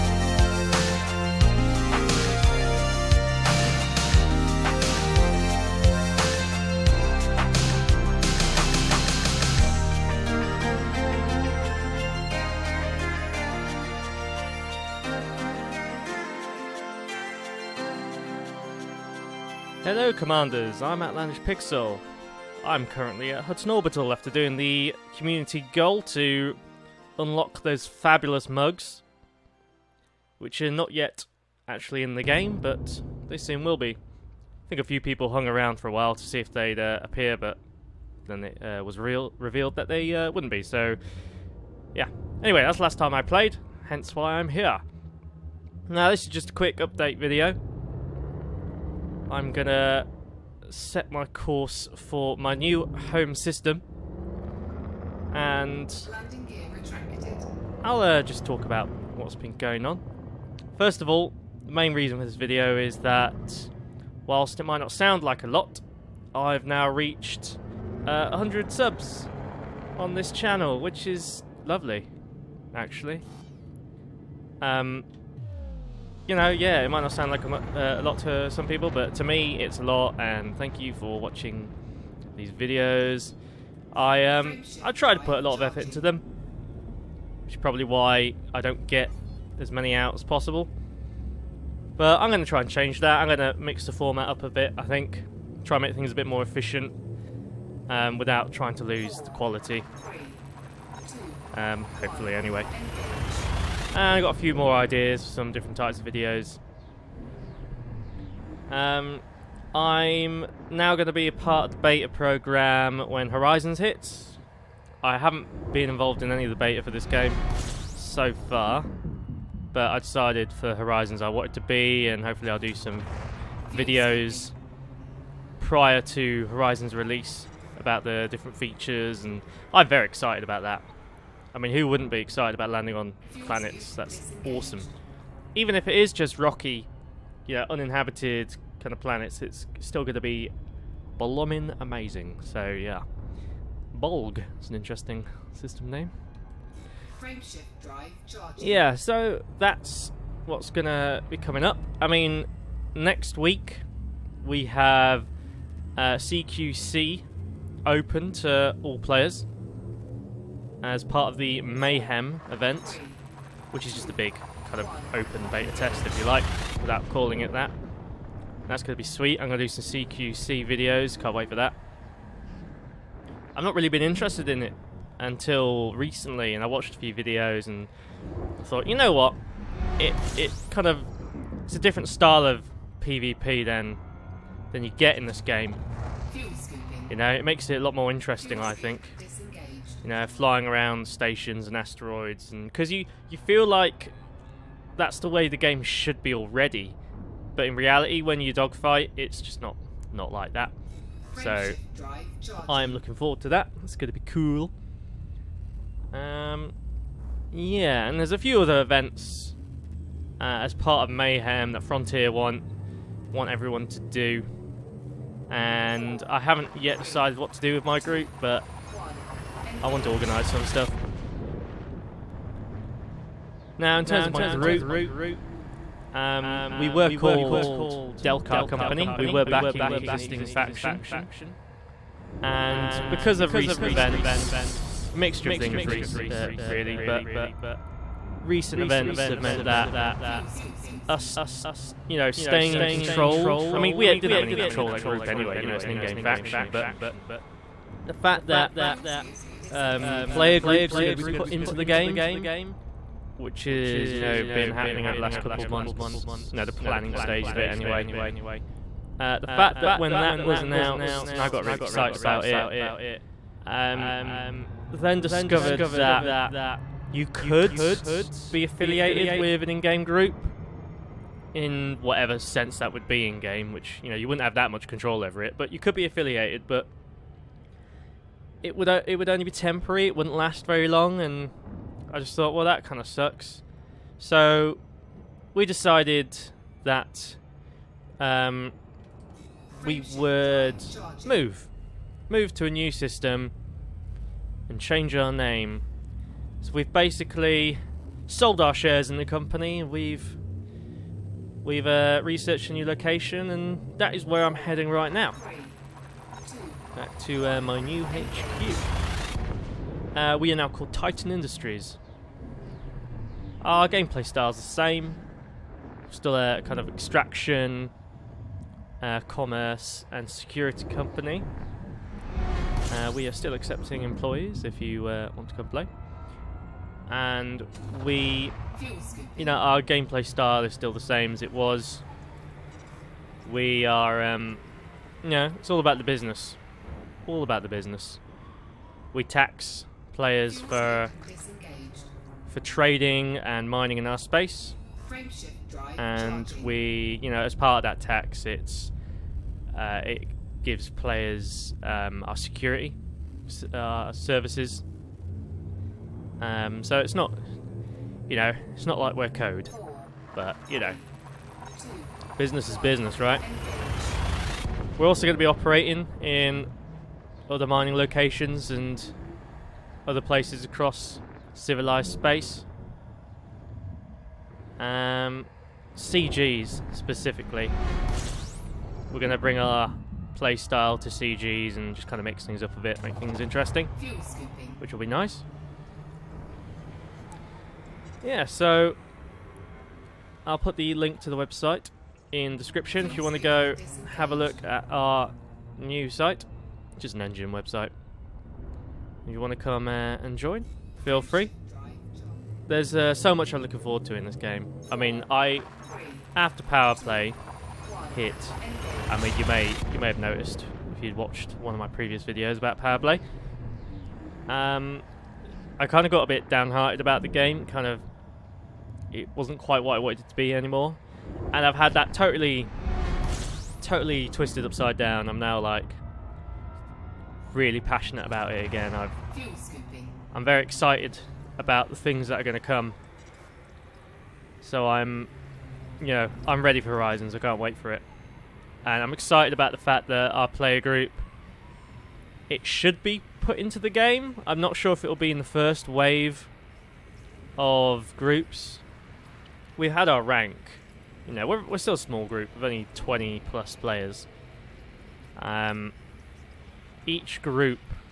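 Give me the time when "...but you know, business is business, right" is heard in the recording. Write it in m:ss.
6:00.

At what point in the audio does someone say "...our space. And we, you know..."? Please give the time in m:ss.
5:44.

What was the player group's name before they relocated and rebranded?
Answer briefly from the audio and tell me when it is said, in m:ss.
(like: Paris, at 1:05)
Delcar Company, at 3:48.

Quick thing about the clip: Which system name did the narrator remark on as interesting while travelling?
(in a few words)
Bolg.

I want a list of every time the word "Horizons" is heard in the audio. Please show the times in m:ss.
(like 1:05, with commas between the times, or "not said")
1:53, 2:00, 2:06, 7:16.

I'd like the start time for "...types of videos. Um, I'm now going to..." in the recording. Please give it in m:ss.
1:45.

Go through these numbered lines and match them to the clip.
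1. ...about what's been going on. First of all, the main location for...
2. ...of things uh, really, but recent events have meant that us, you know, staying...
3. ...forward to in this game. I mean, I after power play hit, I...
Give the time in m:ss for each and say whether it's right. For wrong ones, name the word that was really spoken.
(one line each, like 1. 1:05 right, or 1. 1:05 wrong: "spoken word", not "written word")
1. 0:58 wrong: "reason", not "location"
2. 3:55 right
3. 6:43 right.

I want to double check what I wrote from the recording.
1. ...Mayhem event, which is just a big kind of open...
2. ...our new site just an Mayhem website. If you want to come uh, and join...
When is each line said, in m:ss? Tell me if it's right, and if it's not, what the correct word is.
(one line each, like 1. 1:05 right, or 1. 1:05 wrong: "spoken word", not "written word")
1. 2:41 right
2. 6:34 wrong: "Enjin", not "Mayhem".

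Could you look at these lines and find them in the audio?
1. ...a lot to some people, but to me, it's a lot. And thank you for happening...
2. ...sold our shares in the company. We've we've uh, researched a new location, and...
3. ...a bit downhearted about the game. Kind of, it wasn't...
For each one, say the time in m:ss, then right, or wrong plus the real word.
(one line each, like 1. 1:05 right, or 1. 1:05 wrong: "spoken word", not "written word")
1. 1:17 wrong: "watching", not "happening"
2. 4:58 right
3. 6:56 right.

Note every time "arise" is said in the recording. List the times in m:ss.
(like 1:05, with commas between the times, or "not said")
not said.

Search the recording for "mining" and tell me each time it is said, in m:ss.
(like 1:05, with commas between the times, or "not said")
5:43, 6:07.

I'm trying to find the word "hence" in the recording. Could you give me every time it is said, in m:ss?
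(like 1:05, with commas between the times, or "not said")
0:43.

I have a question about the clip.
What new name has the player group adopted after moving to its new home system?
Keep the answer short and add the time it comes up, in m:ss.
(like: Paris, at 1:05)
Titan Industries, at 5:10.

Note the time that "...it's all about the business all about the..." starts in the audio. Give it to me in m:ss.
5:35.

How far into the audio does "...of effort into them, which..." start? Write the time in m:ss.
1:25.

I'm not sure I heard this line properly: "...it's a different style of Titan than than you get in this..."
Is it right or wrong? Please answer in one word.
wrong.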